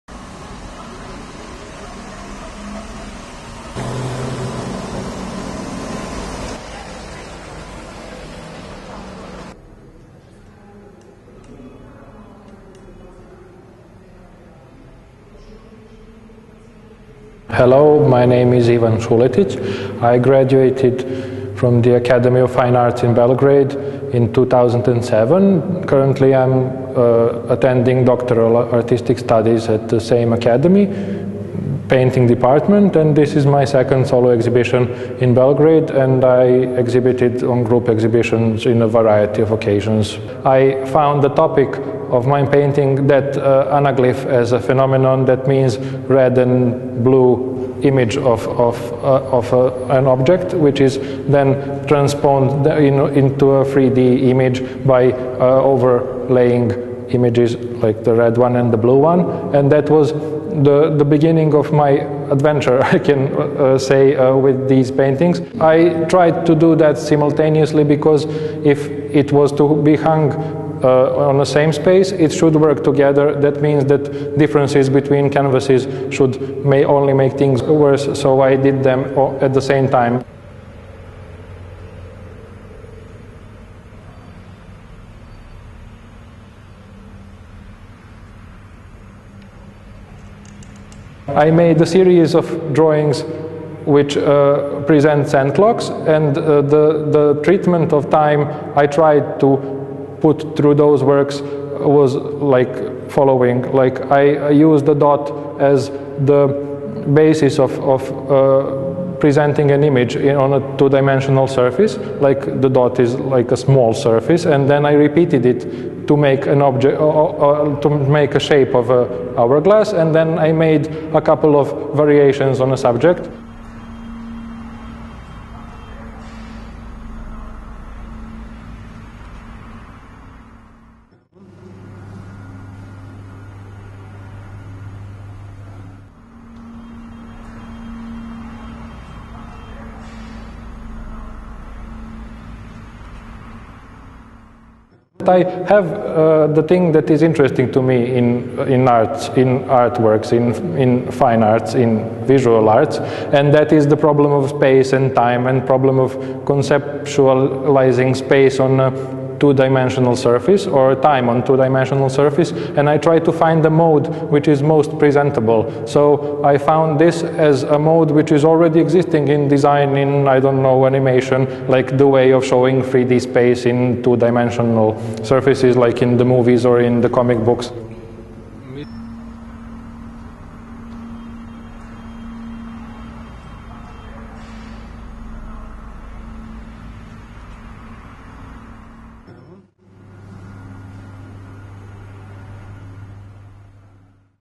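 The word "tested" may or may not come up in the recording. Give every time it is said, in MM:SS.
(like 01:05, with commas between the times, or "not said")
not said.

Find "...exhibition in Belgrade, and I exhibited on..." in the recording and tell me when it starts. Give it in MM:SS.
00:34.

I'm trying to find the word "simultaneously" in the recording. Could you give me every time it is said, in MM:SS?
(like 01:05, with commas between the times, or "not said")
01:06.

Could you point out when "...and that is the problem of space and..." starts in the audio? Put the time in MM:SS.
02:33.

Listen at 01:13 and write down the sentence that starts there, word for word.
That means that differences between canvases should may only make things worse, so I did them at the same time.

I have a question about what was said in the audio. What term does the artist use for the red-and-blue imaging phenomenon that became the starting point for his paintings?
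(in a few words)
anaglyph.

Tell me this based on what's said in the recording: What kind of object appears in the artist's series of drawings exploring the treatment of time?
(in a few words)
sand clocks.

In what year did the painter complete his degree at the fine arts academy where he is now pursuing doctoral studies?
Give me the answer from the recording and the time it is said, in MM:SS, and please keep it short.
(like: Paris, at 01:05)
2007, at 00:24.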